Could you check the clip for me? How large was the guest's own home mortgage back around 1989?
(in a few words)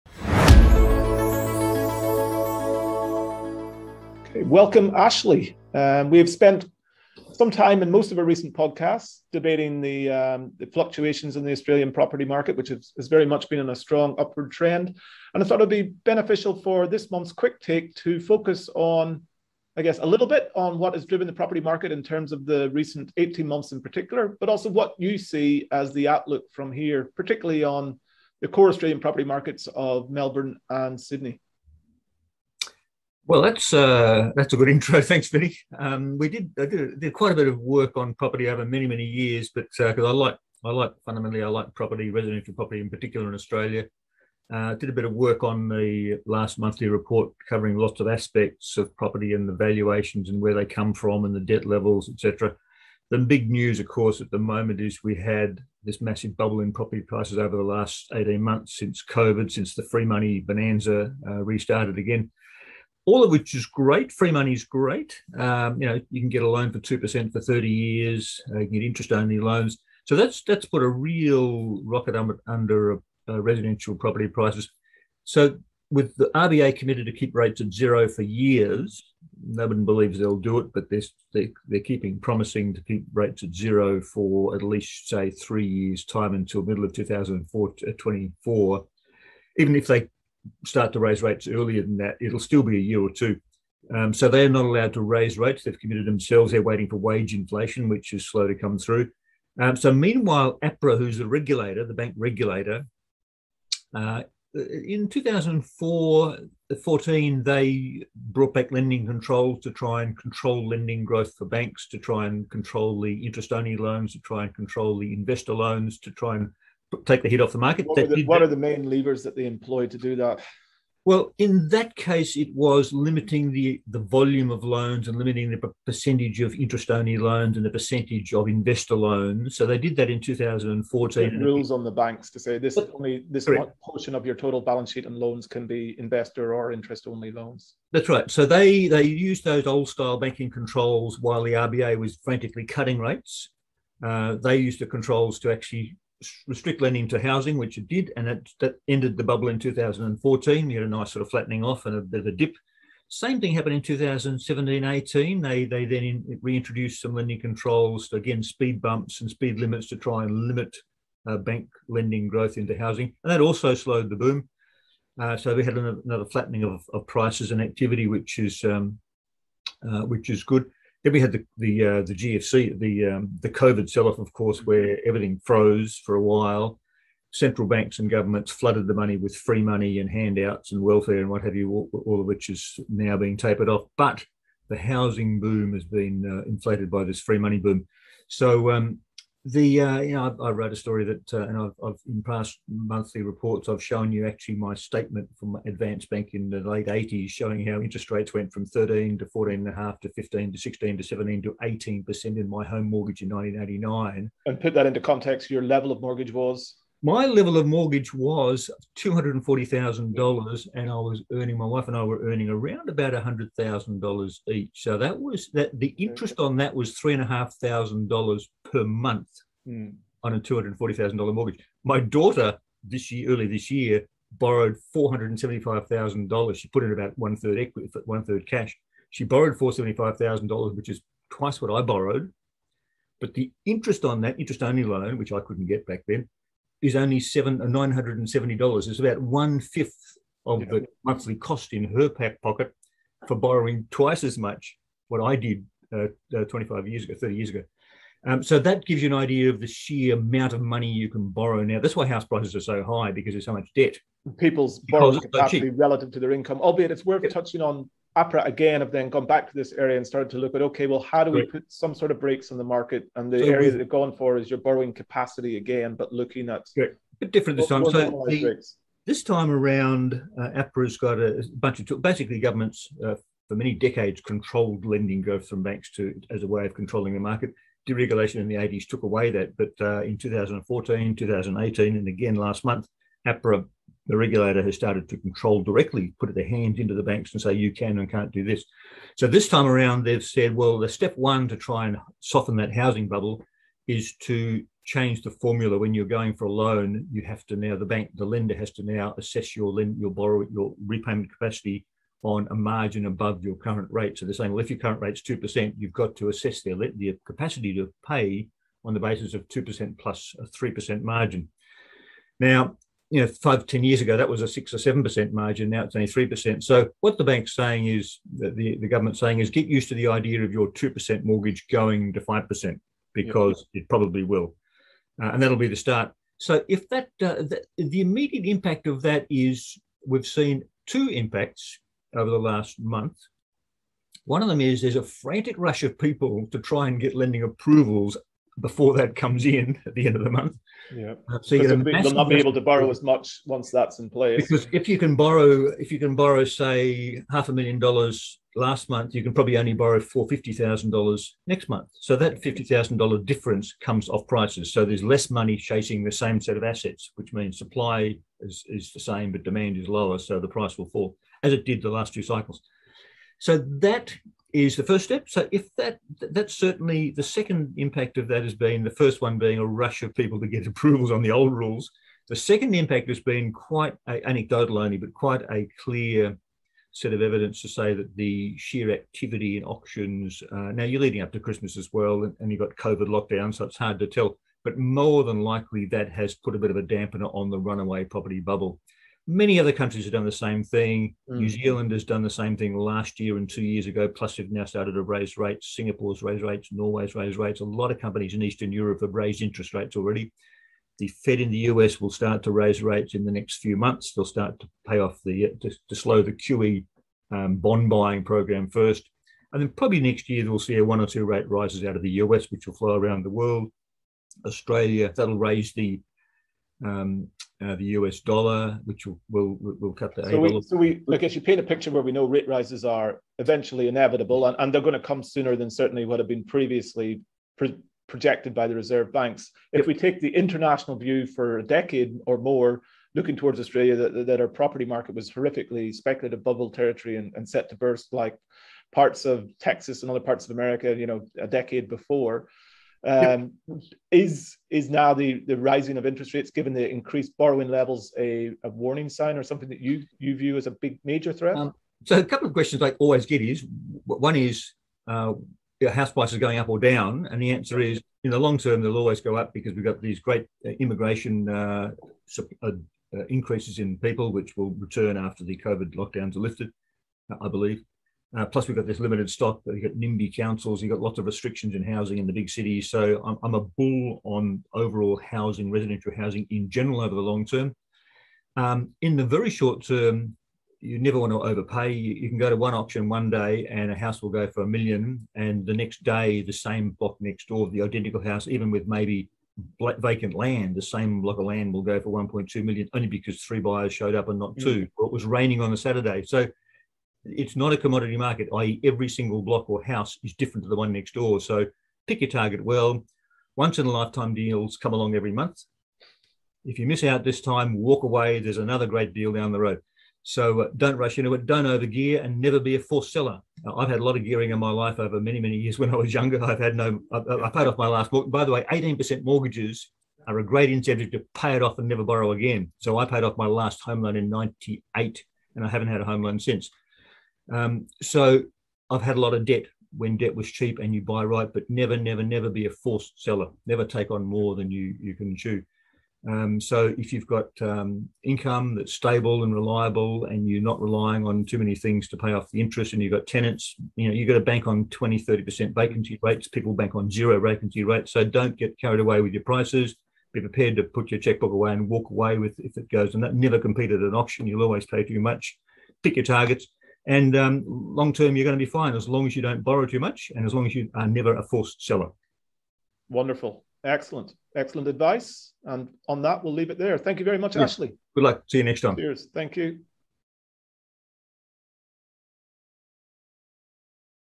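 $240,000.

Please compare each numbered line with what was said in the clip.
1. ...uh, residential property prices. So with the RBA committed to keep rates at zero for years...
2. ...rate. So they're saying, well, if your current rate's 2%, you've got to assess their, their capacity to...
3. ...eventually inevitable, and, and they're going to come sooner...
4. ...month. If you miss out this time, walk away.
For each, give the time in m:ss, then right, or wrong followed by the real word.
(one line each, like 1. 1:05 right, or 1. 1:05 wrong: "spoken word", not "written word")
1. 1:13 right
2. 5:03 right
3. 7:03 right
4. 8:25 right.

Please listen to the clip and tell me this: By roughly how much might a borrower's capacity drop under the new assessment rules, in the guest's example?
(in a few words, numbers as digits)
$50,000.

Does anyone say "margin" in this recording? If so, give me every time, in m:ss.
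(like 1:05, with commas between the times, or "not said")
5:02, 5:11, 5:15.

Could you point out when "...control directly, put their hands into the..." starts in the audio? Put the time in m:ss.
4:45.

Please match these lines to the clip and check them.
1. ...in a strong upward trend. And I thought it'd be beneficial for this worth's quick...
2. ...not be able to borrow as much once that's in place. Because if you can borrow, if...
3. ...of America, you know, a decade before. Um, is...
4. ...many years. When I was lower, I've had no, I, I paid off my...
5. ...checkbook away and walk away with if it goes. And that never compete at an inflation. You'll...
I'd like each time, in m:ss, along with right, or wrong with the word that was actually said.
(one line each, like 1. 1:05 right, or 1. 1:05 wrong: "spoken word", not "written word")
1. 0:13 wrong: "month", not "worth"
2. 5:42 right
3. 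7:20 right
4. 8:35 wrong: "younger", not "lower"
5. 9:11 wrong: "auction", not "inflation".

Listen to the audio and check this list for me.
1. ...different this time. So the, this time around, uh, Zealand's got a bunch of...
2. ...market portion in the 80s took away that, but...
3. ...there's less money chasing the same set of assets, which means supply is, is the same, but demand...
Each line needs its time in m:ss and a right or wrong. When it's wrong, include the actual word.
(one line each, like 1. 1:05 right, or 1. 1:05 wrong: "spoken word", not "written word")
1. 4:27 wrong: "APRA", not "Zealand"
2. 4:37 wrong: "deregulation", not "portion"
3. 5:54 right.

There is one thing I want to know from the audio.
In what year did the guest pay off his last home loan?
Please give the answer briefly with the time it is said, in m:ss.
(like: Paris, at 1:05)
1998, at 8:44.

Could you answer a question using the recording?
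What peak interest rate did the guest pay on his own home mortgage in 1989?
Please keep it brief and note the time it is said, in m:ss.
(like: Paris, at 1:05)
18 percent, at 3:21.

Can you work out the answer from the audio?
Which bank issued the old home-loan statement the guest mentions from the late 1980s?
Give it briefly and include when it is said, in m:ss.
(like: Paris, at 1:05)
Advance Bank, at 3:15.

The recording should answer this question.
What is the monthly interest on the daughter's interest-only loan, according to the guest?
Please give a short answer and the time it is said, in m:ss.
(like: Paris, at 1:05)
$970, at 3:57.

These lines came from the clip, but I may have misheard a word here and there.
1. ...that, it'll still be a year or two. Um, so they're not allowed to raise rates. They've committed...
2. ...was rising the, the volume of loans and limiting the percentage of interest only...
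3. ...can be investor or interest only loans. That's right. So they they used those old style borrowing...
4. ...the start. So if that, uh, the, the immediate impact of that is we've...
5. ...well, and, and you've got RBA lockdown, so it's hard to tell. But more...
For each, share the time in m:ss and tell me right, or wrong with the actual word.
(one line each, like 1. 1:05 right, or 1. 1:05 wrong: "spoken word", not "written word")
1. 1:31 right
2. 2:02 wrong: "limiting", not "rising"
3. 2:15 wrong: "banking", not "borrowing"
4. 5:25 right
5. 6:21 wrong: "COVID", not "RBA".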